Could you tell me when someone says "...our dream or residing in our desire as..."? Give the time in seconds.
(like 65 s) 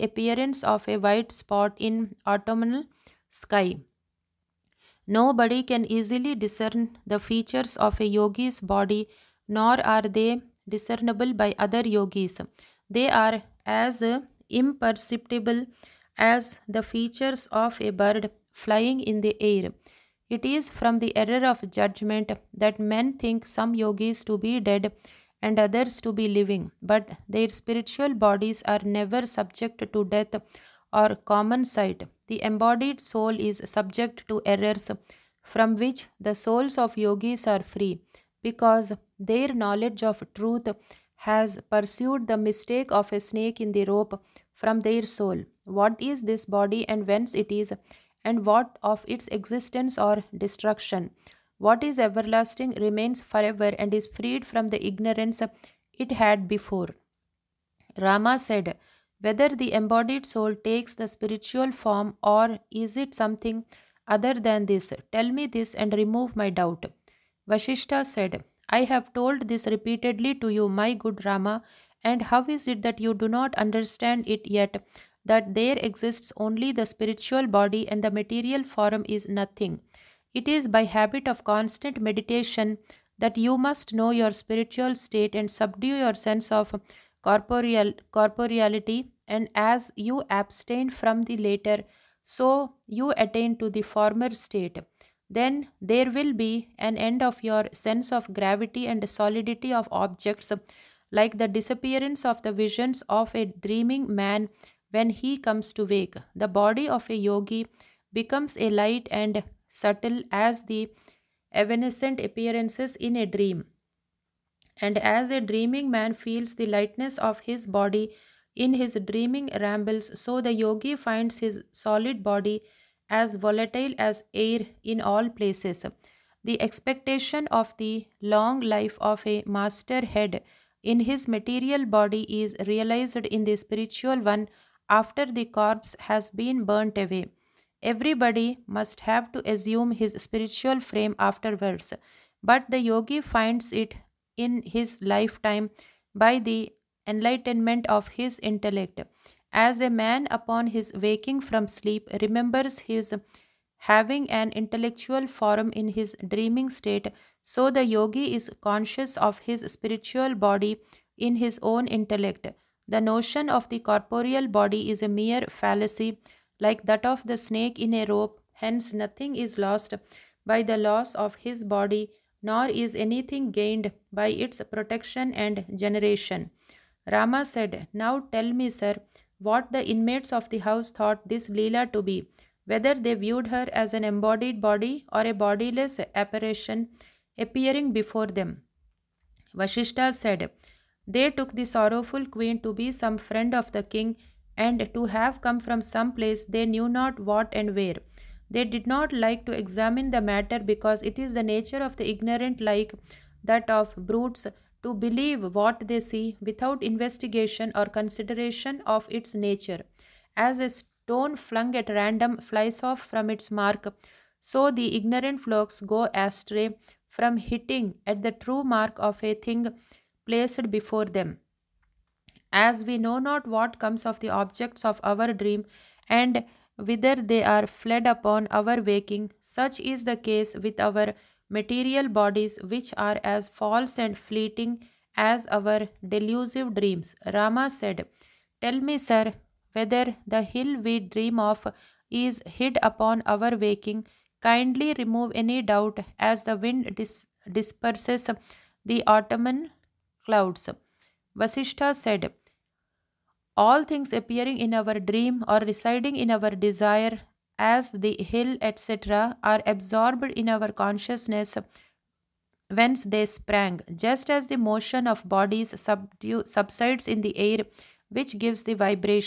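254 s.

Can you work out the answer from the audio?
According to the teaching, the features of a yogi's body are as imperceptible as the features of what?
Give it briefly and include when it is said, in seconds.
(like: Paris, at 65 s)
a bird flying in the air, at 17 s.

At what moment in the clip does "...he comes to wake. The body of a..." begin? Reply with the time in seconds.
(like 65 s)
105 s.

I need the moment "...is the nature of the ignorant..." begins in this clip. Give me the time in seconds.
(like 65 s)
201 s.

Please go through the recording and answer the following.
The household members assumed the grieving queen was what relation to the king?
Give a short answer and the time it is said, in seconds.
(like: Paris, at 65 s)
some friend, at 192 s.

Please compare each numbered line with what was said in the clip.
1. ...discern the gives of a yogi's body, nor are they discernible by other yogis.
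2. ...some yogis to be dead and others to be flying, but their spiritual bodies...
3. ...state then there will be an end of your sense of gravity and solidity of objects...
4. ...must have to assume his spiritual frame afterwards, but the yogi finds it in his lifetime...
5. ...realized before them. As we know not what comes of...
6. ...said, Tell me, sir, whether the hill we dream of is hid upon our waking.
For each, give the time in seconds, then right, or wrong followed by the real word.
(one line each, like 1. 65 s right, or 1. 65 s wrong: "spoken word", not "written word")
1. 6 s wrong: "features", not "gives"
2. 23 s wrong: "living", not "flying"
3. 94 s right
4. 138 s right
5. 220 s wrong: "placed", not "realized"
6. 237 s right.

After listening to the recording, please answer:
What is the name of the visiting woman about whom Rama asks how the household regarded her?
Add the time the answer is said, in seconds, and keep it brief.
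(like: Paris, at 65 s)
Leela, at 181 s.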